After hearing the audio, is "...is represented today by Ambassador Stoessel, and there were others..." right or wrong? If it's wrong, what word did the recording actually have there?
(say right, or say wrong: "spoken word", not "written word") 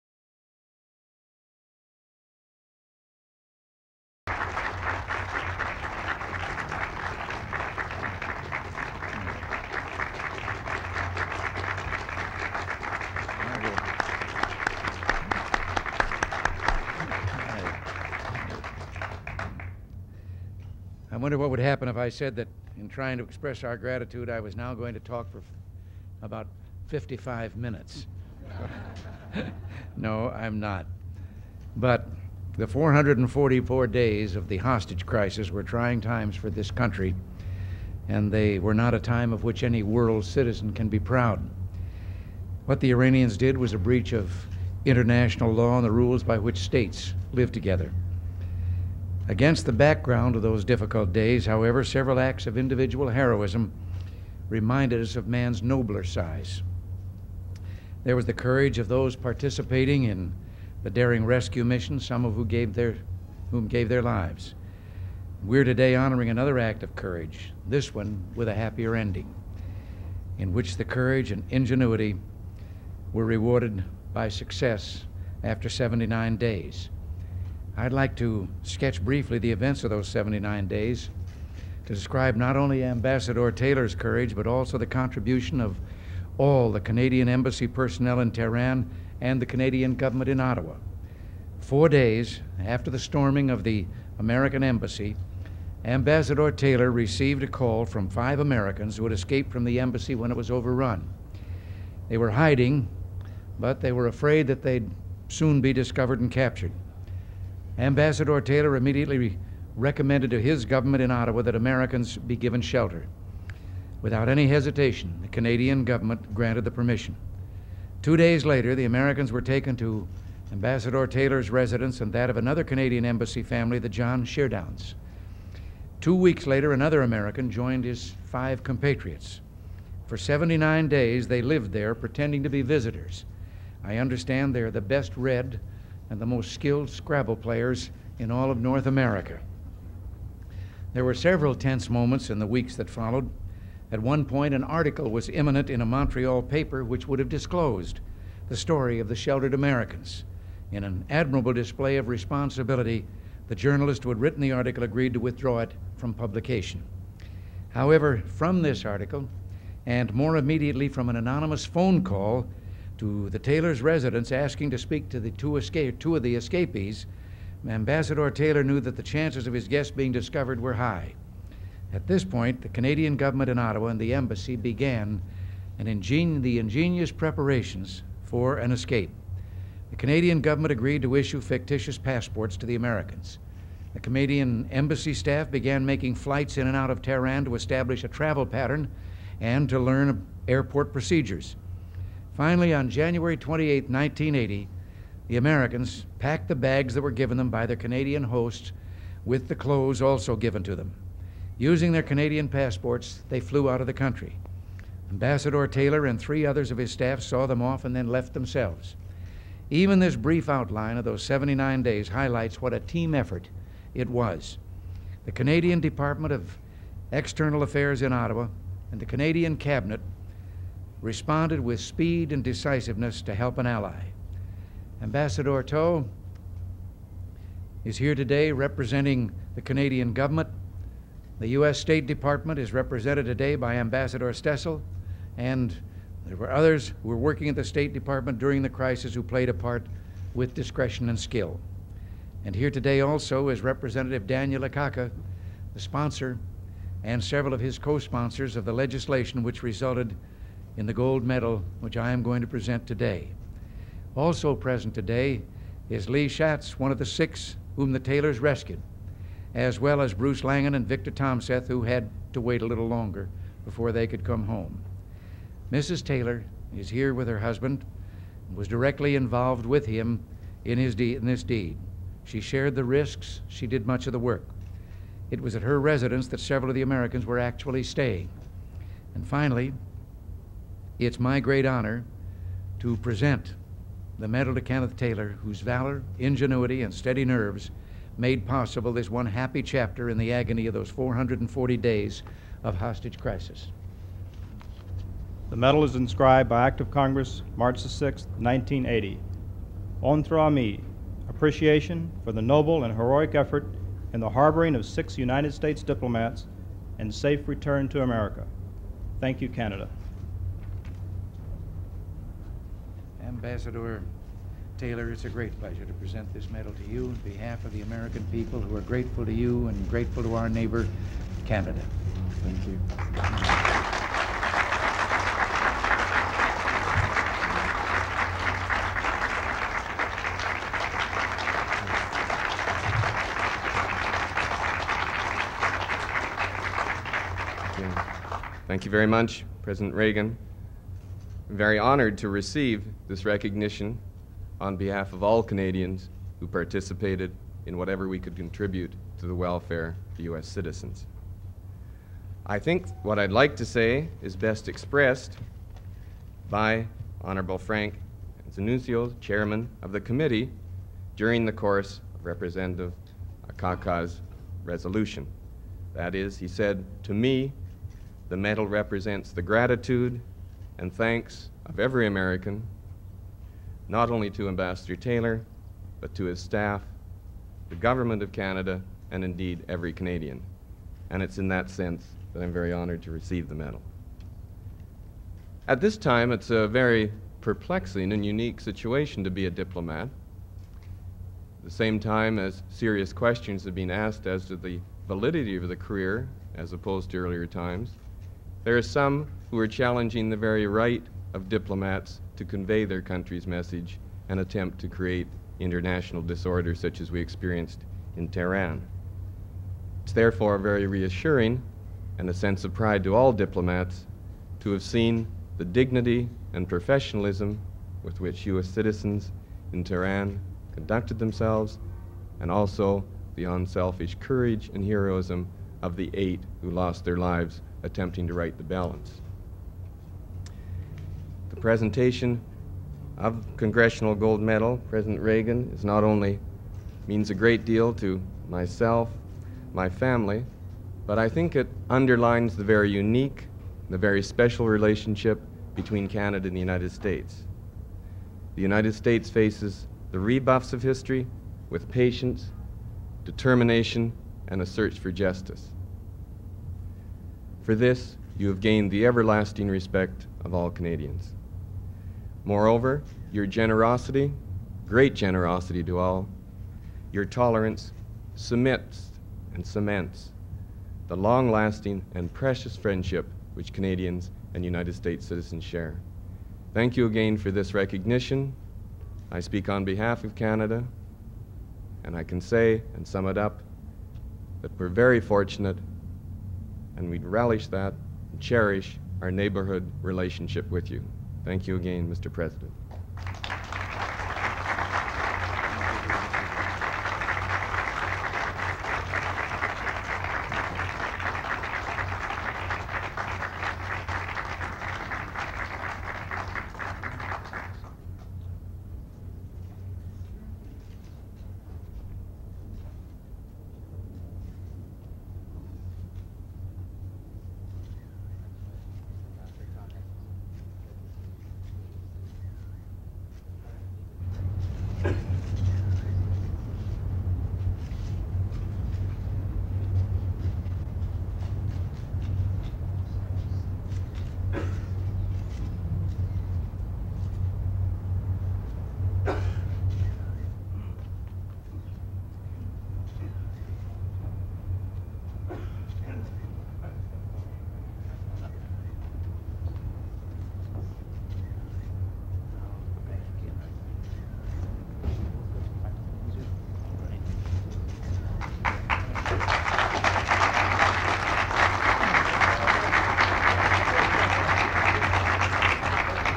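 right.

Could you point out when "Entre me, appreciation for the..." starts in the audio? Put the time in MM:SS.
05:00.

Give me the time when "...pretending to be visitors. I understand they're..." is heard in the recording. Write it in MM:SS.
02:11.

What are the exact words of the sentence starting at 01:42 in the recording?
They were hiding, but they were afraid that they'd soon be discovered and captured.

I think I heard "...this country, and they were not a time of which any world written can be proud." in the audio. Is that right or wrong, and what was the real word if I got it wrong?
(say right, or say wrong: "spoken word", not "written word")
wrong: "citizen", not "written".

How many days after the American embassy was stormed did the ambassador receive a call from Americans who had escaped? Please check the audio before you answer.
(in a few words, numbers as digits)
Four.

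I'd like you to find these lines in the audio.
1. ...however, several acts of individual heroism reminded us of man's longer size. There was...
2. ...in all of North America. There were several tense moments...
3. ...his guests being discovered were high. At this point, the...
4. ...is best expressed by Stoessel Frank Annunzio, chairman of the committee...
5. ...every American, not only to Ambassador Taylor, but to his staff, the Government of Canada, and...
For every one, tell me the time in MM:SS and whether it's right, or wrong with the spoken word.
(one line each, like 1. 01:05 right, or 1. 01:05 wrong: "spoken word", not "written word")
1. 00:51 wrong: "nobler", not "longer"
2. 02:18 right
3. 02:49 right
4. 05:54 wrong: "Honorable", not "Stoessel"
5. 06:11 right.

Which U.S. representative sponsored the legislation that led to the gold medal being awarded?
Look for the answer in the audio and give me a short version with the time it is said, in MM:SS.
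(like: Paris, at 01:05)
Daniel Akaka, at 04:04.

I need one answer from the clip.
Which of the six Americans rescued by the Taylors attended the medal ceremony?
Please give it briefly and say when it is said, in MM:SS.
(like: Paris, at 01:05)
Lee Schatz, at 04:16.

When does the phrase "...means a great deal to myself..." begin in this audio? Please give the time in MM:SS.
07:17.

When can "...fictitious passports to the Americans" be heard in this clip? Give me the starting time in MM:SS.
03:01.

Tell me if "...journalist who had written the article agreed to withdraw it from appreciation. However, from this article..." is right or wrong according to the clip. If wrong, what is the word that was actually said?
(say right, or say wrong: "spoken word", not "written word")
wrong: "publication", not "appreciation".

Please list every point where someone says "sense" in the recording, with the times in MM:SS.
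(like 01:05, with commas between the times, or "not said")
06:21, 06:52.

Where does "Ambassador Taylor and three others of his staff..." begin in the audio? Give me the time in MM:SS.
03:25.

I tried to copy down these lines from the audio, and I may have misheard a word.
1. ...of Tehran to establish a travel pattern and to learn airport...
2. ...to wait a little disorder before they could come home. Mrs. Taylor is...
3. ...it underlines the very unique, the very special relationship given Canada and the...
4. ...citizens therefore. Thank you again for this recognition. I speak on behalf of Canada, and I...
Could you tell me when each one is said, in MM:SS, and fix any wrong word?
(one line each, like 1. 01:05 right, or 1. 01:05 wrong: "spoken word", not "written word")
1. 03:06 right
2. 04:22 wrong: "longer", not "disorder"
3. 07:21 wrong: "between", not "given"
4. 07:55 wrong: "share", not "therefore".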